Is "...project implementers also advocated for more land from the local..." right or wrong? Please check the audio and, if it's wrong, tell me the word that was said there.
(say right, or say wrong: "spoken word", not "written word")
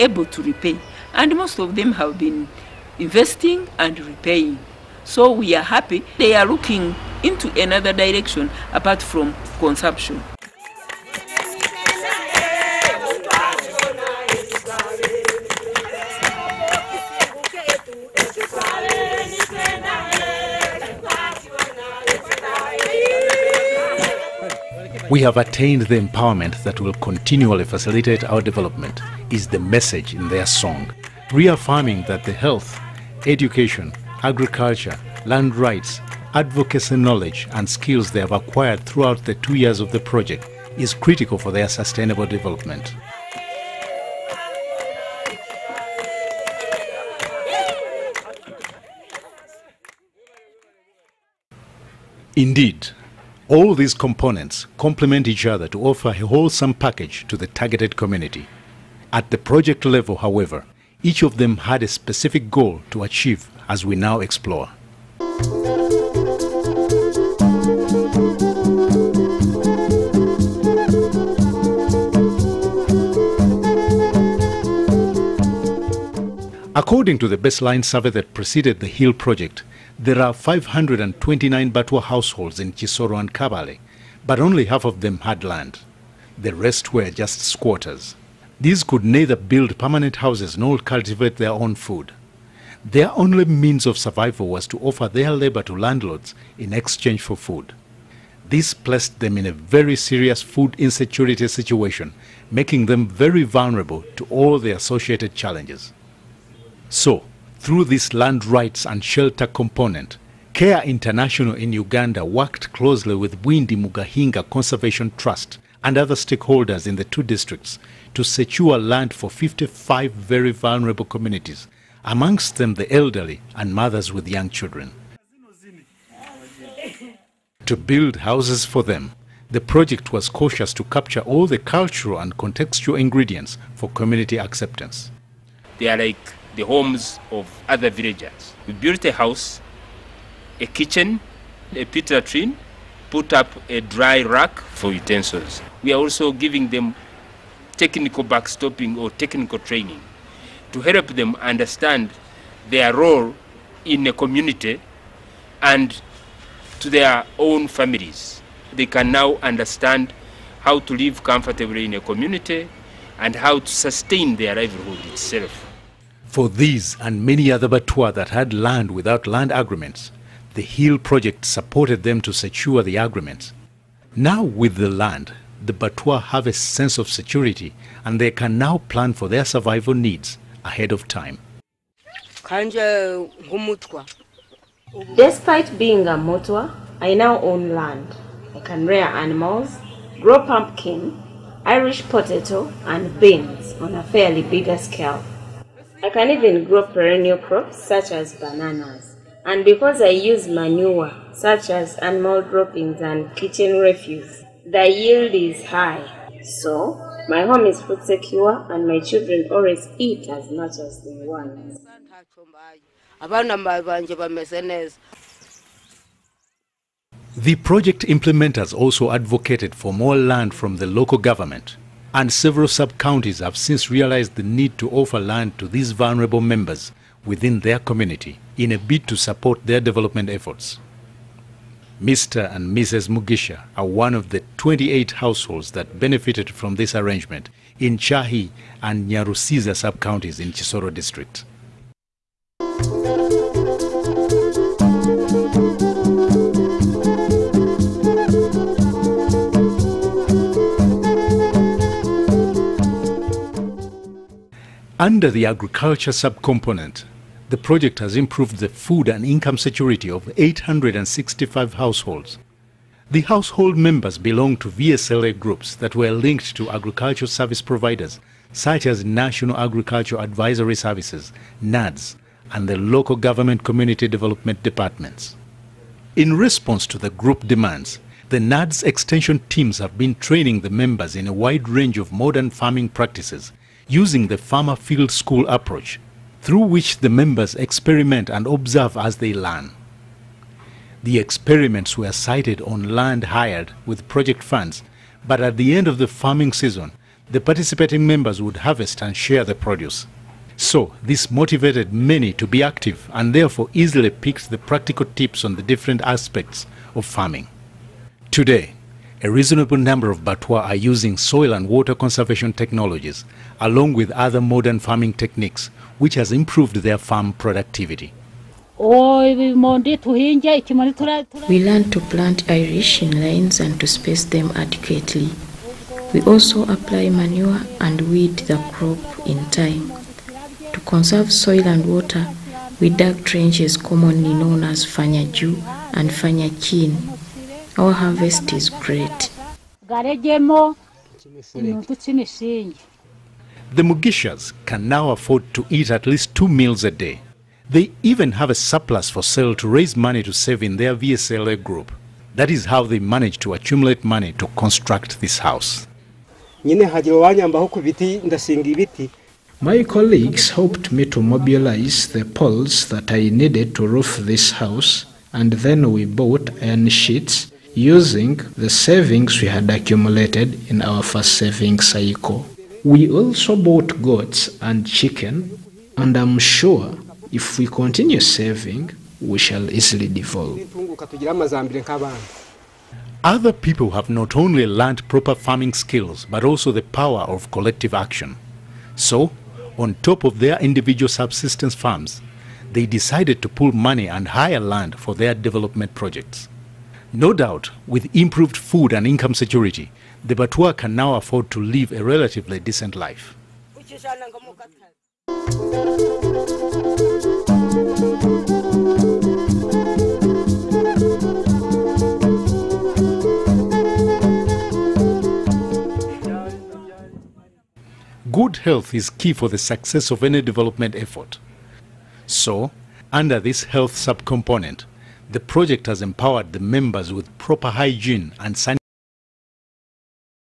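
right.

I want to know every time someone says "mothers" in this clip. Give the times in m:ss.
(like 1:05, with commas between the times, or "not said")
2:03.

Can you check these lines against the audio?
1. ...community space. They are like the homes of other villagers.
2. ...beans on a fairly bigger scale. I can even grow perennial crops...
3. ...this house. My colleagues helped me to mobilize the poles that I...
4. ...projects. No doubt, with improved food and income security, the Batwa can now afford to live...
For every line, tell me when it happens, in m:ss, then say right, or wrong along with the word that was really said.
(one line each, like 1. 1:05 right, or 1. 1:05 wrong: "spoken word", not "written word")
1. 2:13 wrong: "acceptance", not "space"
2. 3:13 right
3. 5:55 right
4. 6:35 right.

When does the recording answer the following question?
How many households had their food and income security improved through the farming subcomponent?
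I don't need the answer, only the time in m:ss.
4:20.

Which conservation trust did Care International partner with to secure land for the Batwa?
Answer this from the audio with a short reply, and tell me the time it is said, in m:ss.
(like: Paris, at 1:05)
Bwindi Mugahinga Conservation Trust, at 1:53.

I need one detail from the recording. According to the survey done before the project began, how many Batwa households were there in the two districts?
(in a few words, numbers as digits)
529.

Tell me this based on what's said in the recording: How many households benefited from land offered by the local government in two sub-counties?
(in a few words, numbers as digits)
28.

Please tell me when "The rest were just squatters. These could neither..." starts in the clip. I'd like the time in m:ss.
1:26.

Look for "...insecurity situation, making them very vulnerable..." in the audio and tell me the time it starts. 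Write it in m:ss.
1:40.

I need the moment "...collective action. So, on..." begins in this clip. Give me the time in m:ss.
6:27.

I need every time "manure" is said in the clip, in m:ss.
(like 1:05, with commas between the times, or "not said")
3:20, 5:27.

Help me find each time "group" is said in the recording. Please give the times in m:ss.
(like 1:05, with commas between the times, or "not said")
4:25, 4:37, 5:51.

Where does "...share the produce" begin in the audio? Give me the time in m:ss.
4:59.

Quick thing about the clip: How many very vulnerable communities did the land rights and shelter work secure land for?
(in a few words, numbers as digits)
55.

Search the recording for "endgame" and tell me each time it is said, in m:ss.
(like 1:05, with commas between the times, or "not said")
not said.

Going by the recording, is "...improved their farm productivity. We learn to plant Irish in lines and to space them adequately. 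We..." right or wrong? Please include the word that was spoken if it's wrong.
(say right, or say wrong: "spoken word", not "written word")
right.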